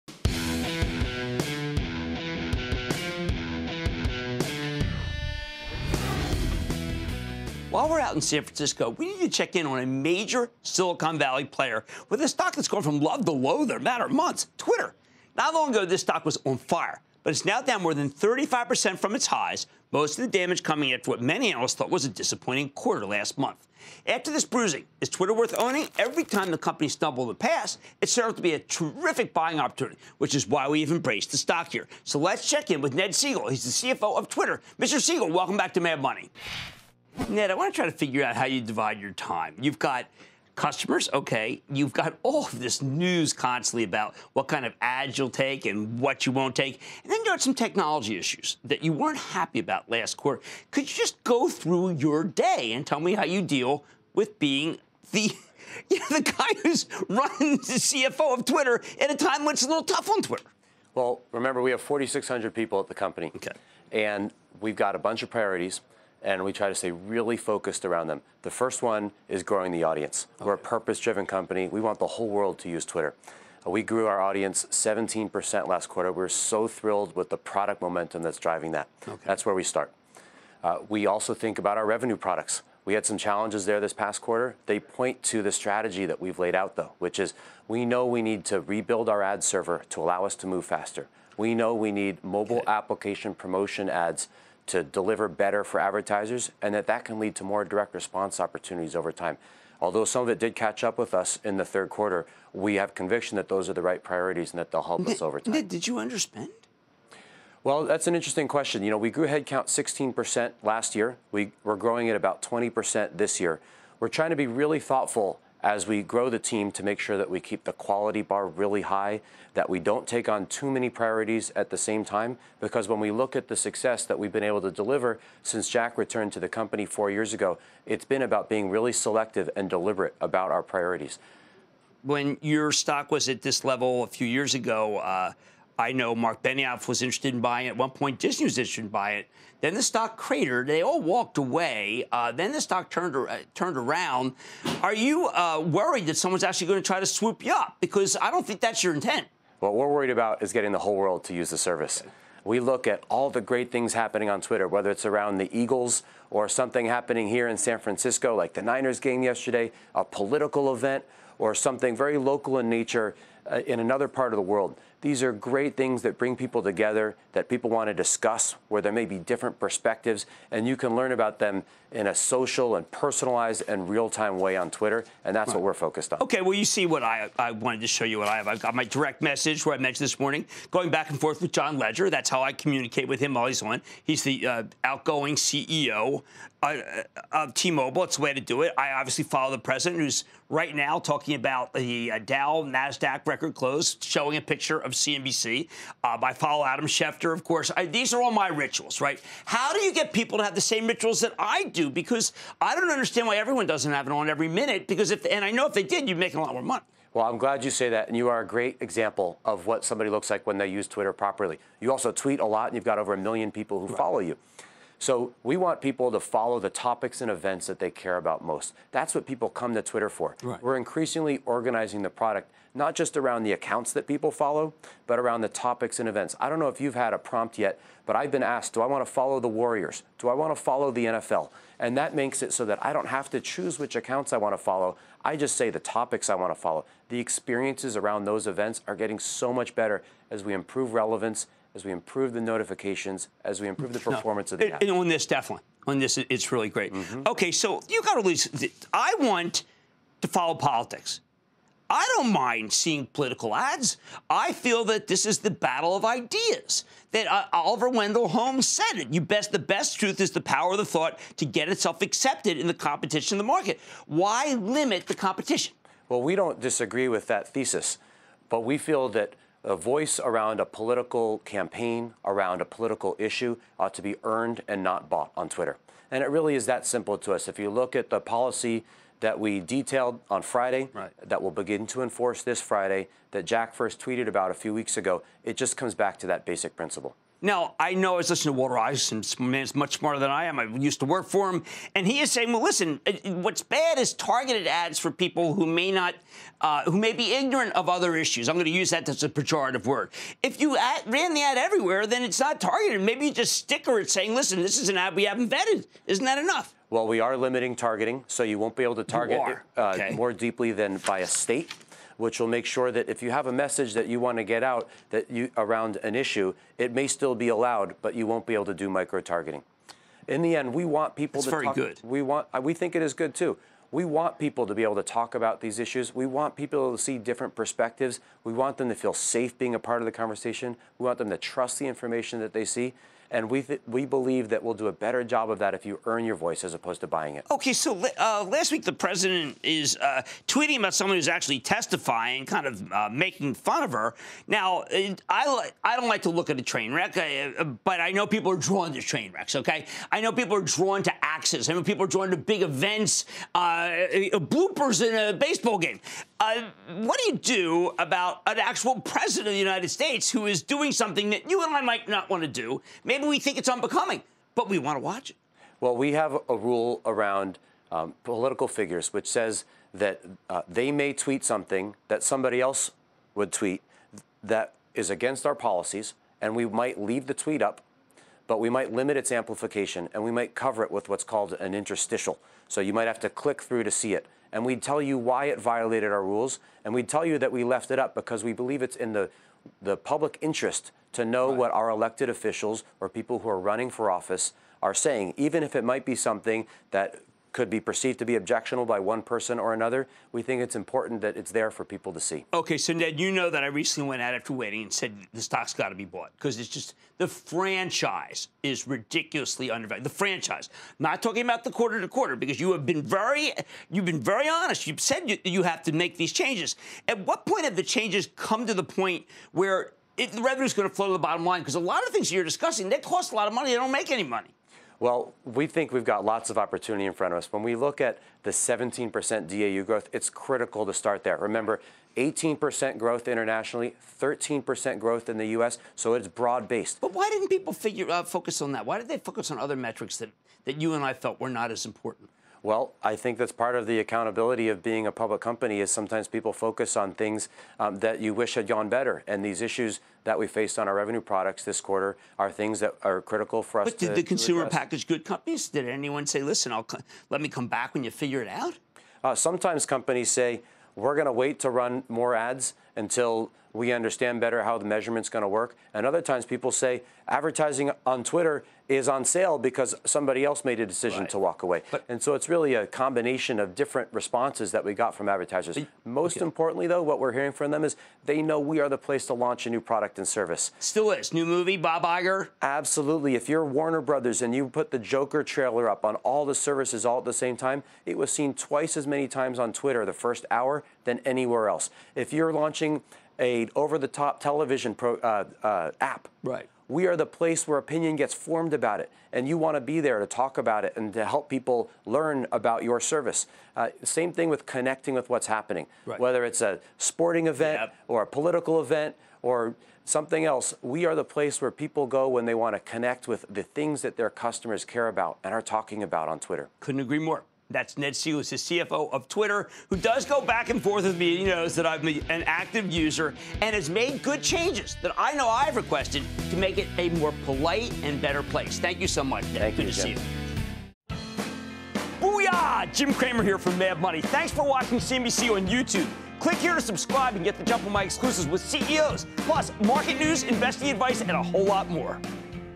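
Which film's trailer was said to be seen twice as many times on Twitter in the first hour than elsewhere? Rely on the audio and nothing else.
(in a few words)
Joker.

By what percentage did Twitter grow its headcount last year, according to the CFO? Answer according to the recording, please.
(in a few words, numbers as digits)
16%.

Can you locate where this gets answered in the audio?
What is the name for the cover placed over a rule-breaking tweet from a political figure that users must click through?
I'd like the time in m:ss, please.
6:21.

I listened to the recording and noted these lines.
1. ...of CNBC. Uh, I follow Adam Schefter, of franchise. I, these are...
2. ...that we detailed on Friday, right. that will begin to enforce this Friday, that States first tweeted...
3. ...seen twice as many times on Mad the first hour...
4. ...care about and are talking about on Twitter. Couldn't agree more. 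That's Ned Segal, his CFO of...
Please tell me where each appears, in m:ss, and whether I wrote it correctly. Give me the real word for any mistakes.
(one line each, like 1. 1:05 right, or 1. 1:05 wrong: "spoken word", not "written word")
1. 3:14 wrong: "course", not "franchise"
2. 4:39 wrong: "Jack", not "States"
3. 8:08 wrong: "Twitter", not "Mad"
4. 8:34 right.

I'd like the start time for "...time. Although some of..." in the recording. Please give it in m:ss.
1:39.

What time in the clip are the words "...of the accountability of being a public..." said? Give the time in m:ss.
7:23.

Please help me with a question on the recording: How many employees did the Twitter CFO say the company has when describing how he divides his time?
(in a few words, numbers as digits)
4,600.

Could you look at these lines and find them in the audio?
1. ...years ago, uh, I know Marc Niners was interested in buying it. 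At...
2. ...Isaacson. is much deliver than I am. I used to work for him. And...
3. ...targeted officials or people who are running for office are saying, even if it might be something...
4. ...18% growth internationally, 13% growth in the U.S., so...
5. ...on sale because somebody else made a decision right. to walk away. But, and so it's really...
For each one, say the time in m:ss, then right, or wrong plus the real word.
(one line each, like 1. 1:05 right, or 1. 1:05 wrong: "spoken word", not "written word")
1. 2:14 wrong: "Benioff", not "Niners"
2. 4:48 wrong: "smarter", not "deliver"
3. 6:31 wrong: "elected", not "targeted"
4. 7:12 right
5. 7:49 right.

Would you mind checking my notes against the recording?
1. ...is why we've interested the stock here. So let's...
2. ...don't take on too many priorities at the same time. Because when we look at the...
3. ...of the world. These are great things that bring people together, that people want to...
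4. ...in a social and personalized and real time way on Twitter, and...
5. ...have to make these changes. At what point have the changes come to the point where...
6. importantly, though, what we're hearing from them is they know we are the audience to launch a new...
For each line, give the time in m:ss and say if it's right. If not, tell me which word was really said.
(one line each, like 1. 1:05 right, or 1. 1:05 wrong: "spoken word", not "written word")
1. 0:30 wrong: "embraced", not "interested"
2. 1:59 right
3. 2:44 right
4. 2:51 right
5. 6:55 right
6. 7:56 wrong: "place", not "audience".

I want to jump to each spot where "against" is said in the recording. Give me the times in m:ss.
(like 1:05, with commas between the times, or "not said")
6:15.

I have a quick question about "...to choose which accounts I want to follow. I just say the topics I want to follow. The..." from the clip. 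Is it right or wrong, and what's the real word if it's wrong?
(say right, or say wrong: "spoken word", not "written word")
right.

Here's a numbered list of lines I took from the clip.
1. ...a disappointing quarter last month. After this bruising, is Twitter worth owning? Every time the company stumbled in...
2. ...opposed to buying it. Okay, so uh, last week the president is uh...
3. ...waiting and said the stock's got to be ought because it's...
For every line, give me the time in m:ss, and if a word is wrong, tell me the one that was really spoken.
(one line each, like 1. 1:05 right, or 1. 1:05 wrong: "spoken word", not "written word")
1. 0:22 right
2. 5:36 right
3. 6:44 wrong: "bought", not "ought".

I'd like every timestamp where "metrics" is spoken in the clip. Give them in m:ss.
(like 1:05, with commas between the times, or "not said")
7:19.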